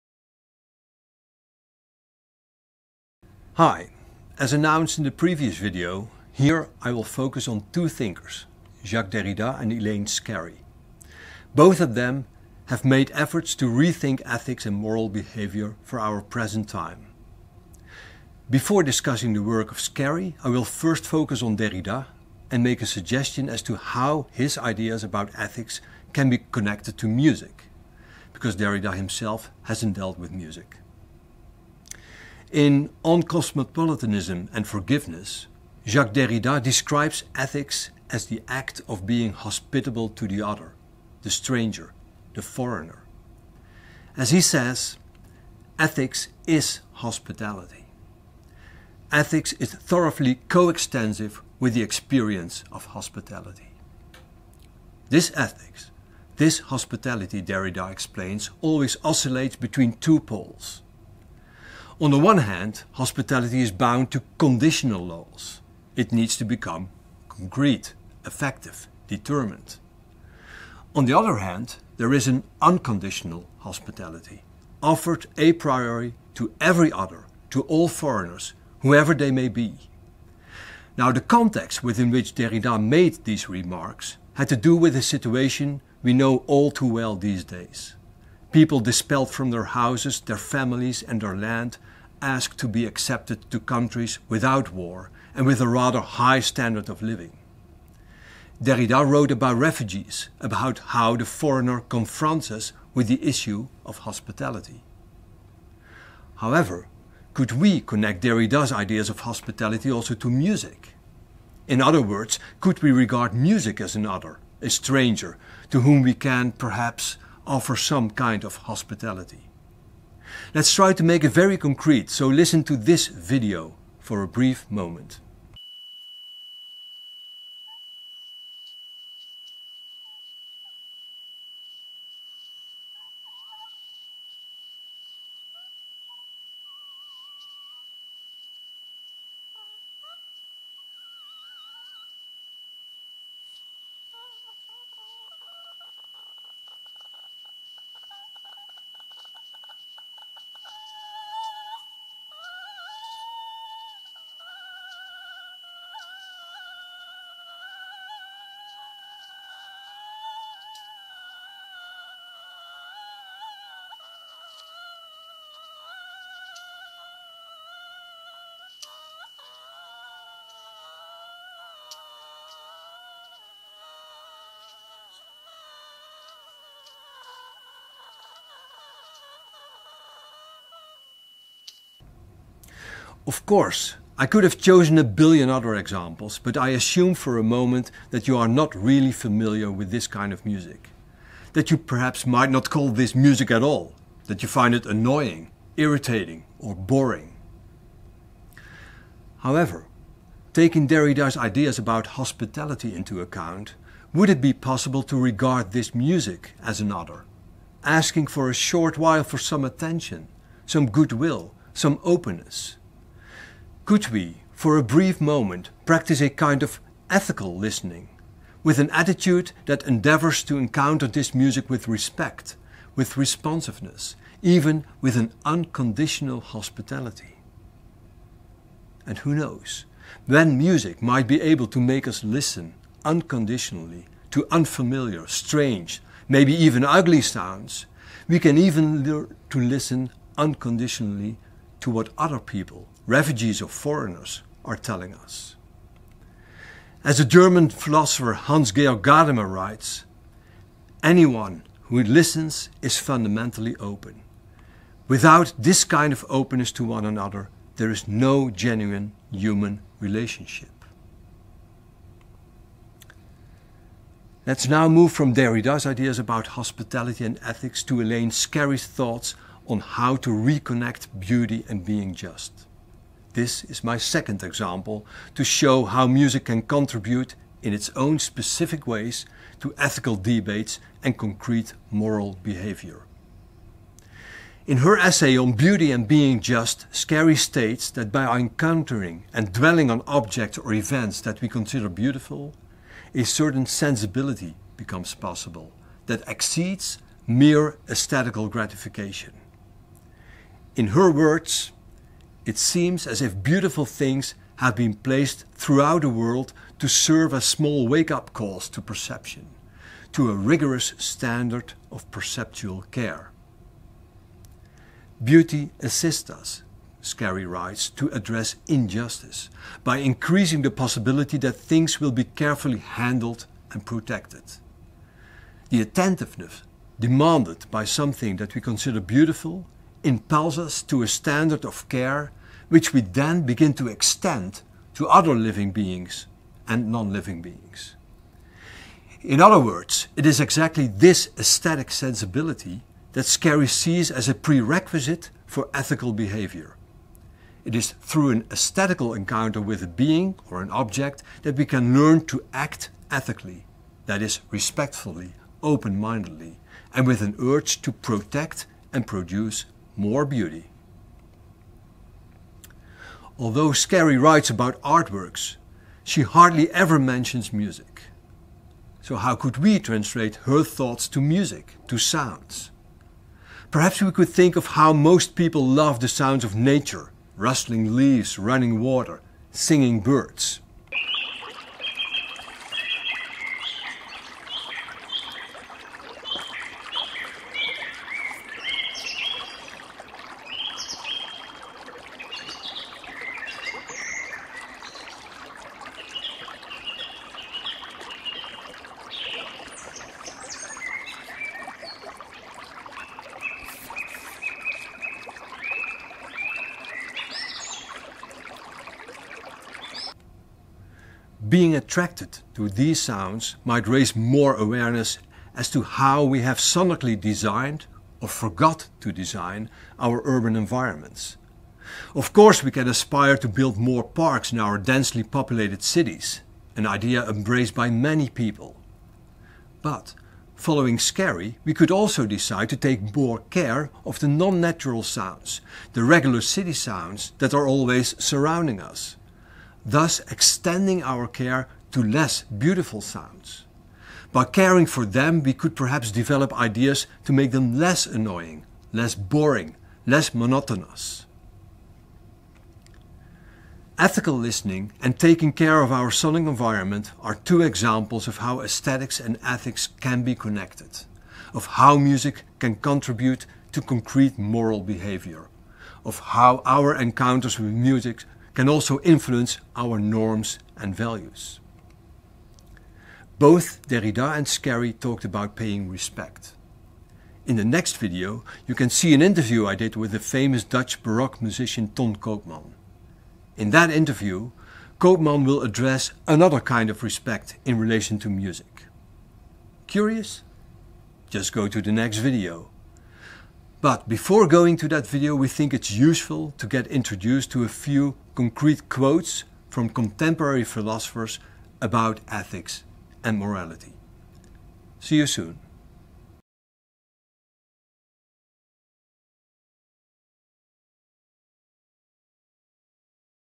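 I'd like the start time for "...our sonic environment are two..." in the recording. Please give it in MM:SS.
07:35.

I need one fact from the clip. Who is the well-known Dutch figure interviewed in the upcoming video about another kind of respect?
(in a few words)
Ton Koopman.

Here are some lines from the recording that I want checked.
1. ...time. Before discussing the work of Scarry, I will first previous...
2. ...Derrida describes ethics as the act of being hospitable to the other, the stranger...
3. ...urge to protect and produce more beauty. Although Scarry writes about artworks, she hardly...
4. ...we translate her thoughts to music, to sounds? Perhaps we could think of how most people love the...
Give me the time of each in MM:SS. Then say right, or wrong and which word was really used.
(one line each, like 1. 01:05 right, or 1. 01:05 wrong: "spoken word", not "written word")
1. 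00:16 wrong: "focus", not "previous"
2. 00:36 right
3. 05:57 right
4. 06:09 right.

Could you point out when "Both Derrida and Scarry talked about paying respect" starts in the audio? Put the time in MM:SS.
07:53.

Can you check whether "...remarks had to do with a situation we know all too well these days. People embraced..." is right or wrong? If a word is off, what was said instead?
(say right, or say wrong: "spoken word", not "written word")
wrong: "dispelled", not "embraced".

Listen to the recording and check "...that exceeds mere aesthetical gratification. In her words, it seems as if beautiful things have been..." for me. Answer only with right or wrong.
right.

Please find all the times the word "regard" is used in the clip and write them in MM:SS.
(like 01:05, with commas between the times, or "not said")
01:52, 03:25.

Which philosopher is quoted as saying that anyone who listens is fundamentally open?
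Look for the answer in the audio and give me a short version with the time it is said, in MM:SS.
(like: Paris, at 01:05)
Hans Georg Gadamer, at 04:08.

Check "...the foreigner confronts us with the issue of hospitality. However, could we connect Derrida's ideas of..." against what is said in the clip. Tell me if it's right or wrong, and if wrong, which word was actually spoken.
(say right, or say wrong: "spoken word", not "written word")
right.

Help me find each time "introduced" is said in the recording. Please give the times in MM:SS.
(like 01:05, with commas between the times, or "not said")
08:16.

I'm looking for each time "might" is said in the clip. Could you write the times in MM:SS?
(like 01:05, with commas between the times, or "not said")
03:12, 03:51, 06:53.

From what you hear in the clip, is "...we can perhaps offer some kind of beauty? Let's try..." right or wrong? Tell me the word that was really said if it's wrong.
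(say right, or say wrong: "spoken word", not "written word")
wrong: "hospitality", not "beauty".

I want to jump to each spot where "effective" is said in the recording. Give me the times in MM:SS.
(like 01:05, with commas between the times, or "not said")
01:08.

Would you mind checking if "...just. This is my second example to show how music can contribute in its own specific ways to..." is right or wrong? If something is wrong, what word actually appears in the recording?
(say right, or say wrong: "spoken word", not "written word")
right.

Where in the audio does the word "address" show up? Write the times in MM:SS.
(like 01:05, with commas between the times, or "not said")
05:18, 08:05.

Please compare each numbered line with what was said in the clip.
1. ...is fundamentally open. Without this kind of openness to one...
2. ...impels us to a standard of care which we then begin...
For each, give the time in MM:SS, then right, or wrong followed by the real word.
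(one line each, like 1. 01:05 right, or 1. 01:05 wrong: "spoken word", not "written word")
1. 04:12 right
2. 05:30 right.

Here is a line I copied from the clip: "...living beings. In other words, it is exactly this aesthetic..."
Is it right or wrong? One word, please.
right.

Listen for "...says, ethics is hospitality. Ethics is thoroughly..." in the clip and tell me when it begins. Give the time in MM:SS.
00:44.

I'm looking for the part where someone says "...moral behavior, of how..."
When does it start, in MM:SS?
07:44.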